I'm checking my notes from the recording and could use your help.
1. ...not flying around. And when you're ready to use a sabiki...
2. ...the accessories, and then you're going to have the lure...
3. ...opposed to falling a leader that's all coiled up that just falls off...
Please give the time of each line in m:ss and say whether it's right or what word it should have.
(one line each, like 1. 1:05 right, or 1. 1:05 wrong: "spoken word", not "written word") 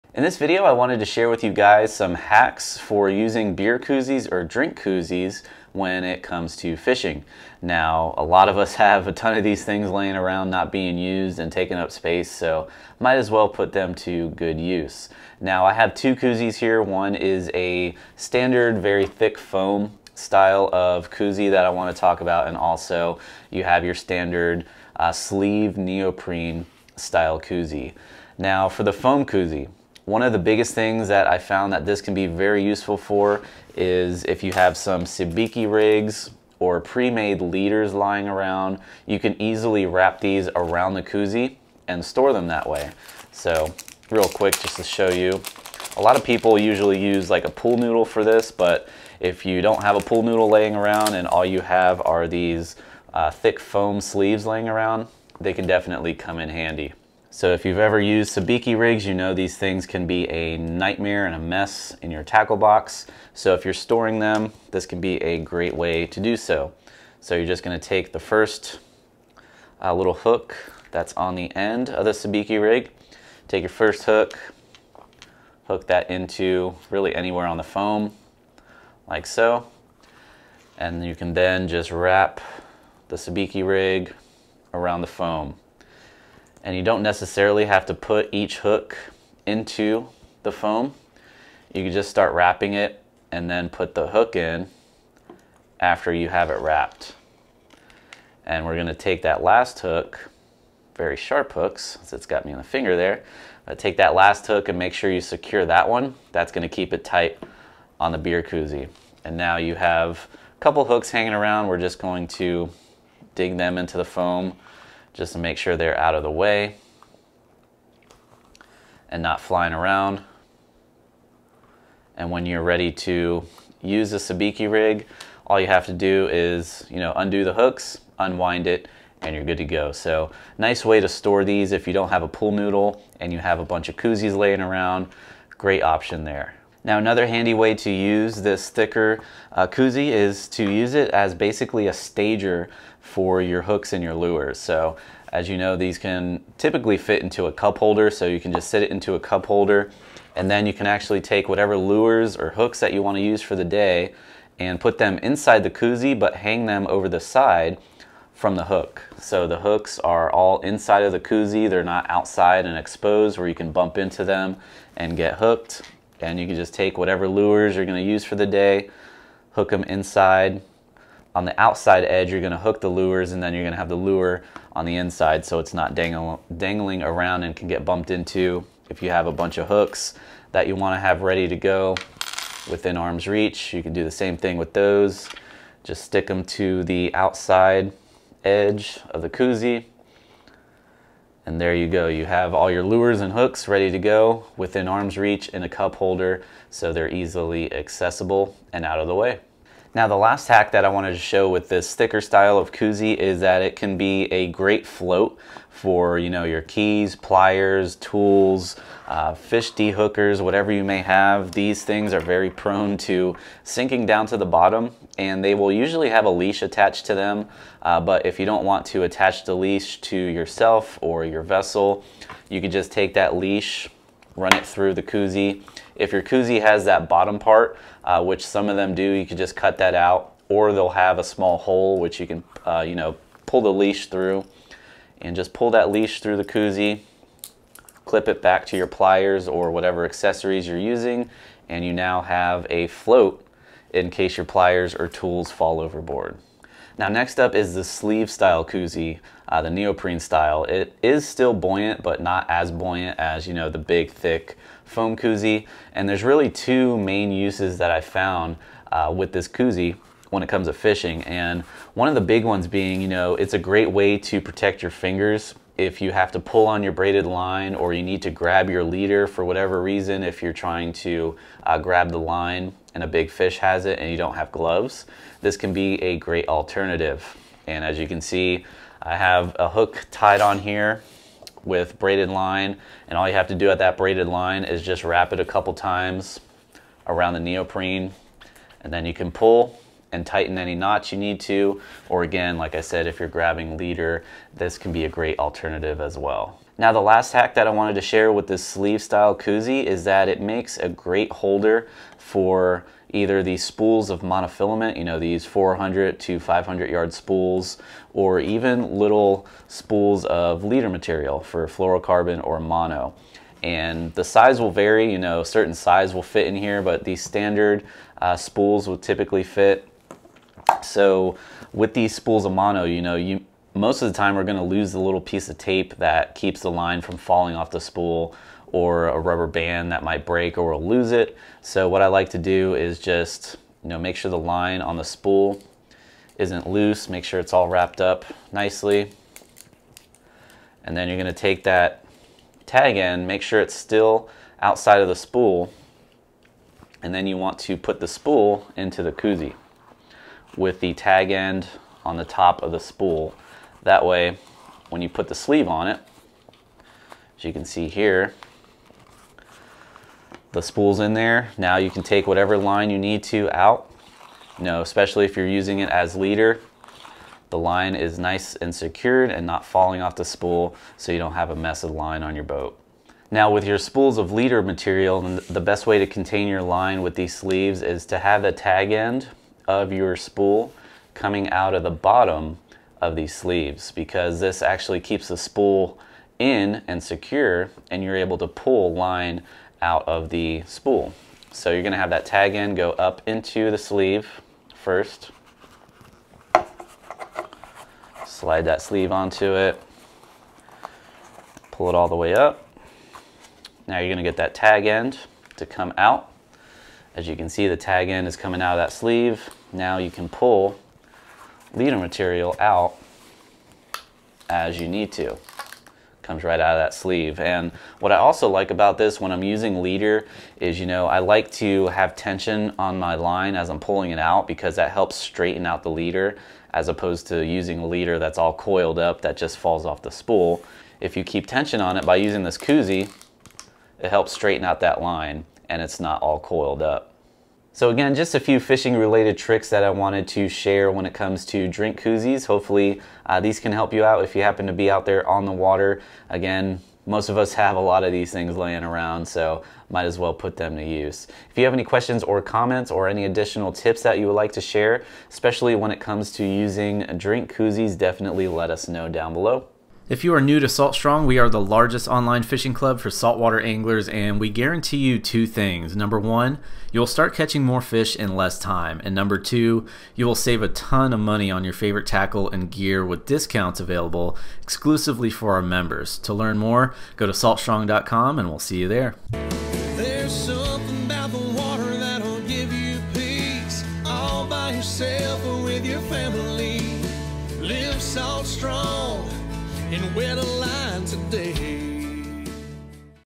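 1. 1:59 right
2. 2:52 wrong: "lures", not "accessories"
3. 7:06 wrong: "using", not "falling".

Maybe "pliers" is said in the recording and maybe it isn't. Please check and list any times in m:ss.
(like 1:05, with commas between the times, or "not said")
3:27, 3:58, 4:04.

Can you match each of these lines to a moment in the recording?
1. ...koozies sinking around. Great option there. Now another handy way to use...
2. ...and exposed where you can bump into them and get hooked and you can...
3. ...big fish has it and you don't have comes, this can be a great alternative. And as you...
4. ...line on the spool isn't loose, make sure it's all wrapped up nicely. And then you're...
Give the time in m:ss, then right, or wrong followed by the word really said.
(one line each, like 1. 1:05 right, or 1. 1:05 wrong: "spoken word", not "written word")
1. 2:13 wrong: "laying", not "sinking"
2. 2:42 right
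3. 4:33 wrong: "gloves", not "comes"
4. 5:34 right.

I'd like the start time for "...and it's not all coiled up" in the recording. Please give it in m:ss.
7:15.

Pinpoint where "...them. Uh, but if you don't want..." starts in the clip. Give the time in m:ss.
3:37.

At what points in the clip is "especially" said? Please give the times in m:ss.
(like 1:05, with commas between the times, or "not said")
6:04, 7:35.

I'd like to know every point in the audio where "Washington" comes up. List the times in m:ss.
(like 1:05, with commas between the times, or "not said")
not said.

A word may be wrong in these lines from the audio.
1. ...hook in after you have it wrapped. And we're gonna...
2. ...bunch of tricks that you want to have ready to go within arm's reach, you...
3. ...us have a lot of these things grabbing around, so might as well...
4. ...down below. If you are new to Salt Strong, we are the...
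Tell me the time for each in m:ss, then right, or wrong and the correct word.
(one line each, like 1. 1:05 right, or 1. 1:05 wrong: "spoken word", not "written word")
1. 1:34 right
2. 2:59 wrong: "hooks", not "tricks"
3. 7:27 wrong: "laying", not "grabbing"
4. 7:39 right.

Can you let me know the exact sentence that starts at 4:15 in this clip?
And there's really two main uses that I found uh, with this koozie when it comes to fishing.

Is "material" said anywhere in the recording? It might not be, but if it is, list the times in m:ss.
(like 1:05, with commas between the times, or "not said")
5:10, 6:14, 6:51.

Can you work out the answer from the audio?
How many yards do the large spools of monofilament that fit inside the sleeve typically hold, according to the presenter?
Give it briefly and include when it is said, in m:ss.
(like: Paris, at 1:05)
400 to 500, at 5:05.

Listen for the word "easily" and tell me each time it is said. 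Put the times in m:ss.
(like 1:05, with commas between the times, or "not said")
0:39, 3:17.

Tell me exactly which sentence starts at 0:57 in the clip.
So if you've ever used sabiki rigs, you know these things can be a nightmare and a mess in your tackle box.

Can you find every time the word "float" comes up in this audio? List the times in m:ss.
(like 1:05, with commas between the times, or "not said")
3:24, 4:02.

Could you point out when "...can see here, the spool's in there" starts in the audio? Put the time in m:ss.
5:57.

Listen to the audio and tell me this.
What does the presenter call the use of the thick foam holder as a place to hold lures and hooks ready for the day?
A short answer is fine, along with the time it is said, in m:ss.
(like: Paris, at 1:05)
a stager, at 2:21.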